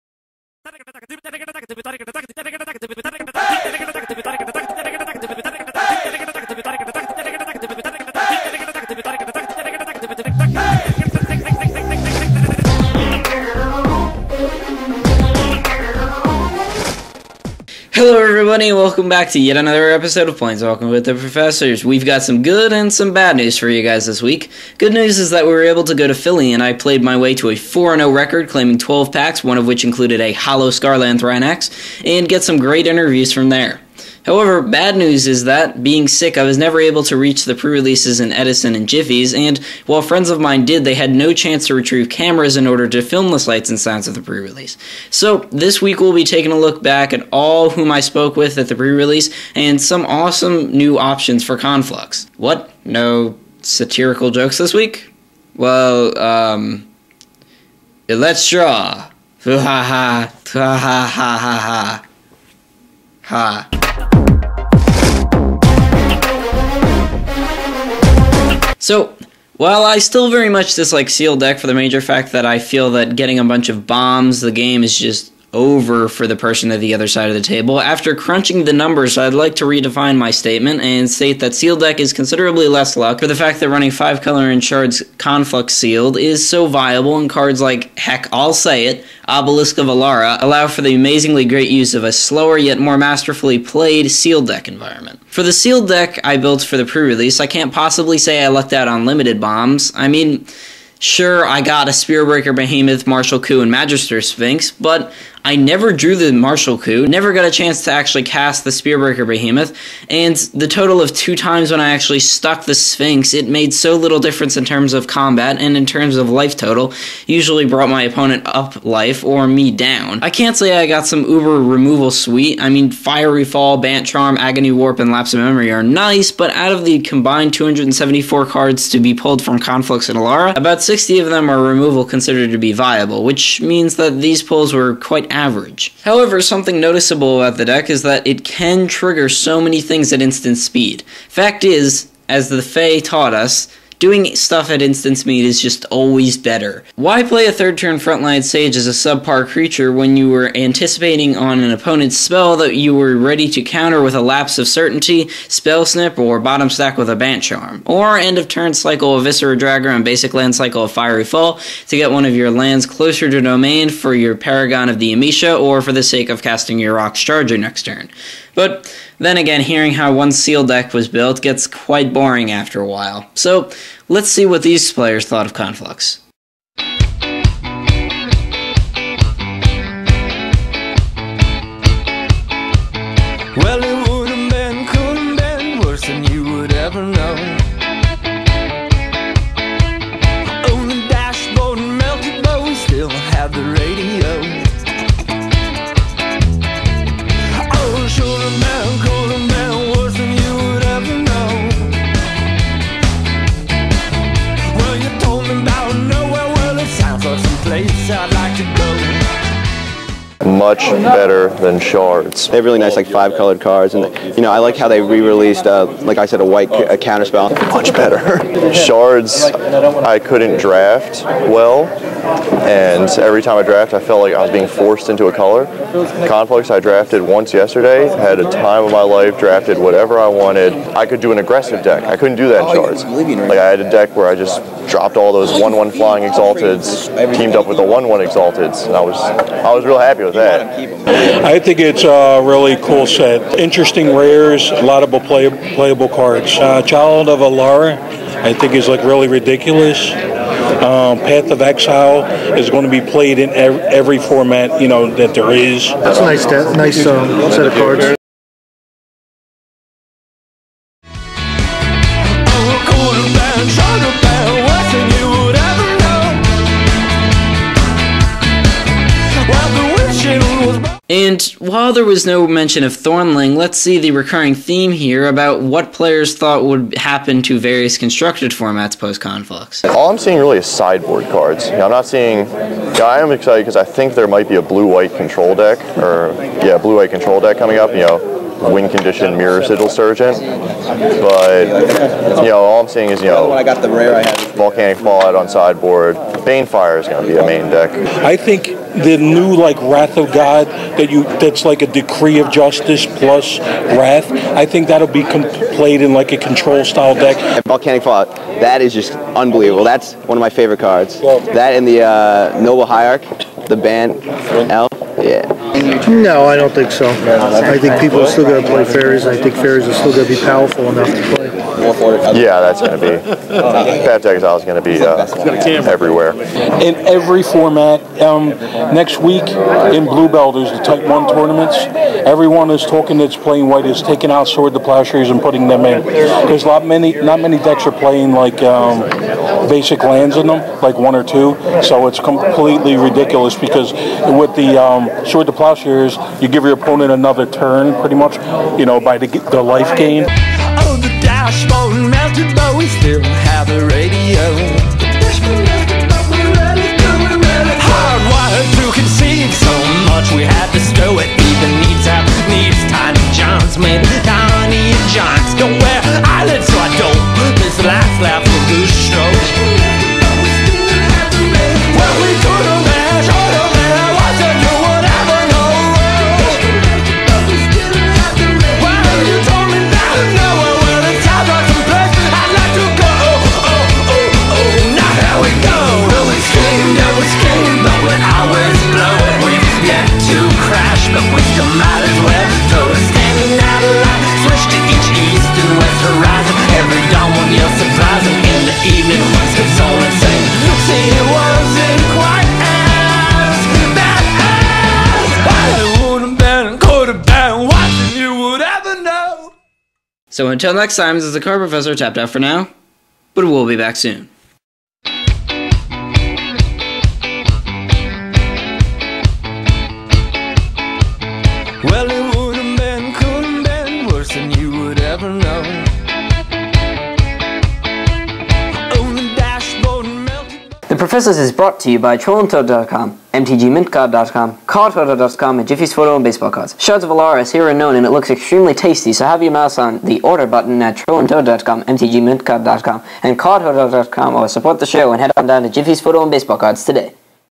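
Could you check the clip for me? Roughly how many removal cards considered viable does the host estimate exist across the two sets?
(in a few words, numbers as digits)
about 60.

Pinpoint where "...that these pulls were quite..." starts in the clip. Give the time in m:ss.
2:13.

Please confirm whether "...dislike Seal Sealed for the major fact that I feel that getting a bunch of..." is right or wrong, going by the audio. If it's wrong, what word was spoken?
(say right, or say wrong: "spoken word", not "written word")
wrong: "Deck", not "Sealed".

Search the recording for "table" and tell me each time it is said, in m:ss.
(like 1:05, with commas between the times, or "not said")
1:17.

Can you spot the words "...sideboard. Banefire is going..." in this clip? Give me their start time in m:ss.
4:55.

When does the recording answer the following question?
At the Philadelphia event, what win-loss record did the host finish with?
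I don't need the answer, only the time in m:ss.
0:27.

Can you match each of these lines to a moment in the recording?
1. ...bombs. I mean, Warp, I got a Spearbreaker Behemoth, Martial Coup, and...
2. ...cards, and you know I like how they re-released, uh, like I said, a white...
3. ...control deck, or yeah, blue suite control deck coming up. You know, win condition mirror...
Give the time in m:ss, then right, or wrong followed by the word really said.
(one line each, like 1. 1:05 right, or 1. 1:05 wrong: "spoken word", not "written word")
1. 1:39 wrong: "Sure", not "Warp"
2. 3:33 right
3. 4:45 wrong: "white", not "suite".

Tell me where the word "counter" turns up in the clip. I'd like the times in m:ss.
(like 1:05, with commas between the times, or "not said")
2:33, 3:36.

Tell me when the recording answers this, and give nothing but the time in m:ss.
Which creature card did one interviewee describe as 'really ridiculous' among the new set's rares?
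4:06.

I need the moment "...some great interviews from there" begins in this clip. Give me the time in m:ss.
0:32.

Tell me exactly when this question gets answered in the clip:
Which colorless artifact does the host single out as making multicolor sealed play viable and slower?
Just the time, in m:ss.
1:29.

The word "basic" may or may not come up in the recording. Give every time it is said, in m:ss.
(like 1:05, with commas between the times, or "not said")
2:40, 5:39.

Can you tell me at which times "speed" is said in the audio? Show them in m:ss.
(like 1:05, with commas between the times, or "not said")
2:20, 2:25.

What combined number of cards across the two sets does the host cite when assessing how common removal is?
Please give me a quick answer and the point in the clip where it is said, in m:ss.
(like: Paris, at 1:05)
274, at 2:07.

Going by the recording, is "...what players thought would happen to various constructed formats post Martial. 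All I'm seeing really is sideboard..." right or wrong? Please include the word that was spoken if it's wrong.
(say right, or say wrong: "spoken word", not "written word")
wrong: "Conflux", not "Martial".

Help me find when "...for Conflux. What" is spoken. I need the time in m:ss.
0:51.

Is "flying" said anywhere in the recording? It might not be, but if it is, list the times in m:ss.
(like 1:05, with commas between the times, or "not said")
3:55.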